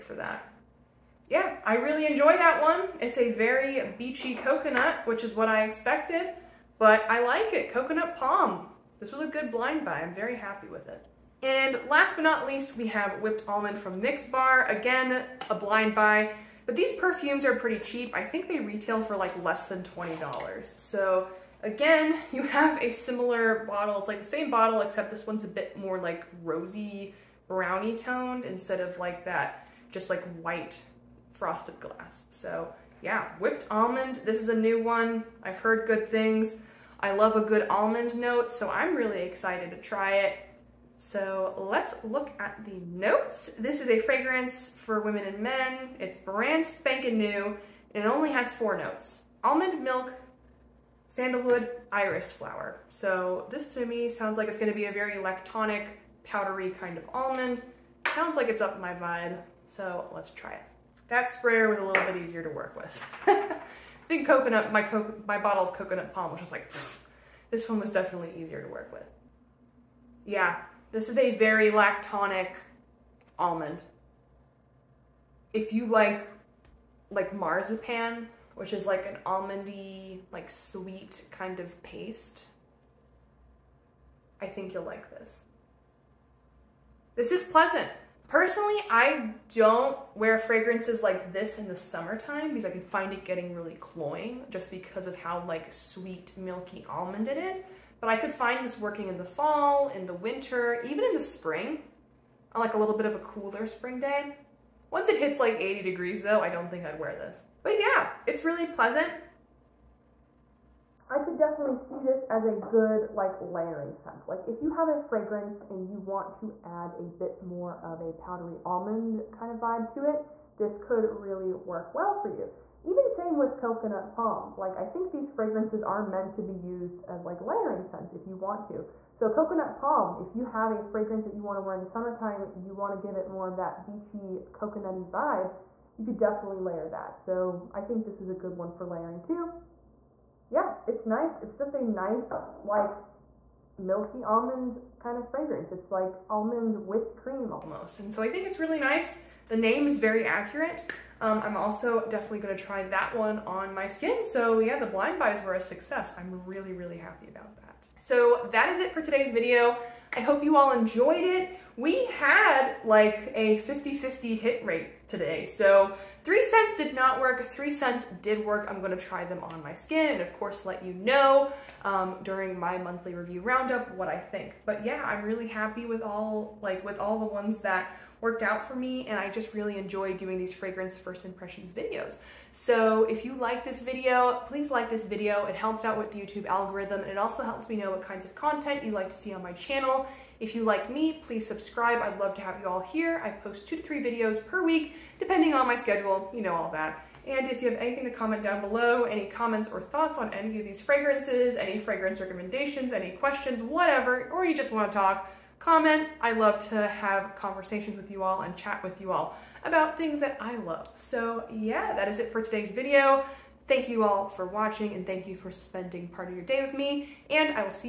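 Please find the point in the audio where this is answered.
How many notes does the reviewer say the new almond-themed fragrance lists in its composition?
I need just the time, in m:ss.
0:48.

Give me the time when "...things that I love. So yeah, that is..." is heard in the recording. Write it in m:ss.
3:29.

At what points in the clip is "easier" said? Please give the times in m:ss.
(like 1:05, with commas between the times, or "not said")
1:02, 1:08.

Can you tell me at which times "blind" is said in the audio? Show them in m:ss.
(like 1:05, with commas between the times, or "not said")
0:09, 0:15, 2:34.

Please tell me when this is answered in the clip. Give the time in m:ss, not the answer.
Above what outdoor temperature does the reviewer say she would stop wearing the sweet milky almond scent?
1:45.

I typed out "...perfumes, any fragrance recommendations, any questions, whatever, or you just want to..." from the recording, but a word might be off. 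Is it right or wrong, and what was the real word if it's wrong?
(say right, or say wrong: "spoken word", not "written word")
wrong: "fragrances", not "perfumes".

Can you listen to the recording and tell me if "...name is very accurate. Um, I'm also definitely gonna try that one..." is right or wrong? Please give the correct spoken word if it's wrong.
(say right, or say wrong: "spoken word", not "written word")
right.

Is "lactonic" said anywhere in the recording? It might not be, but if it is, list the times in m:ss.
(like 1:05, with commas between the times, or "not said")
0:55, 1:11.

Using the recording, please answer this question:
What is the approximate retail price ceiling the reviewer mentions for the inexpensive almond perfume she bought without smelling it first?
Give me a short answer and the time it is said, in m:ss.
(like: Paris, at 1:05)
$20, at 0:19.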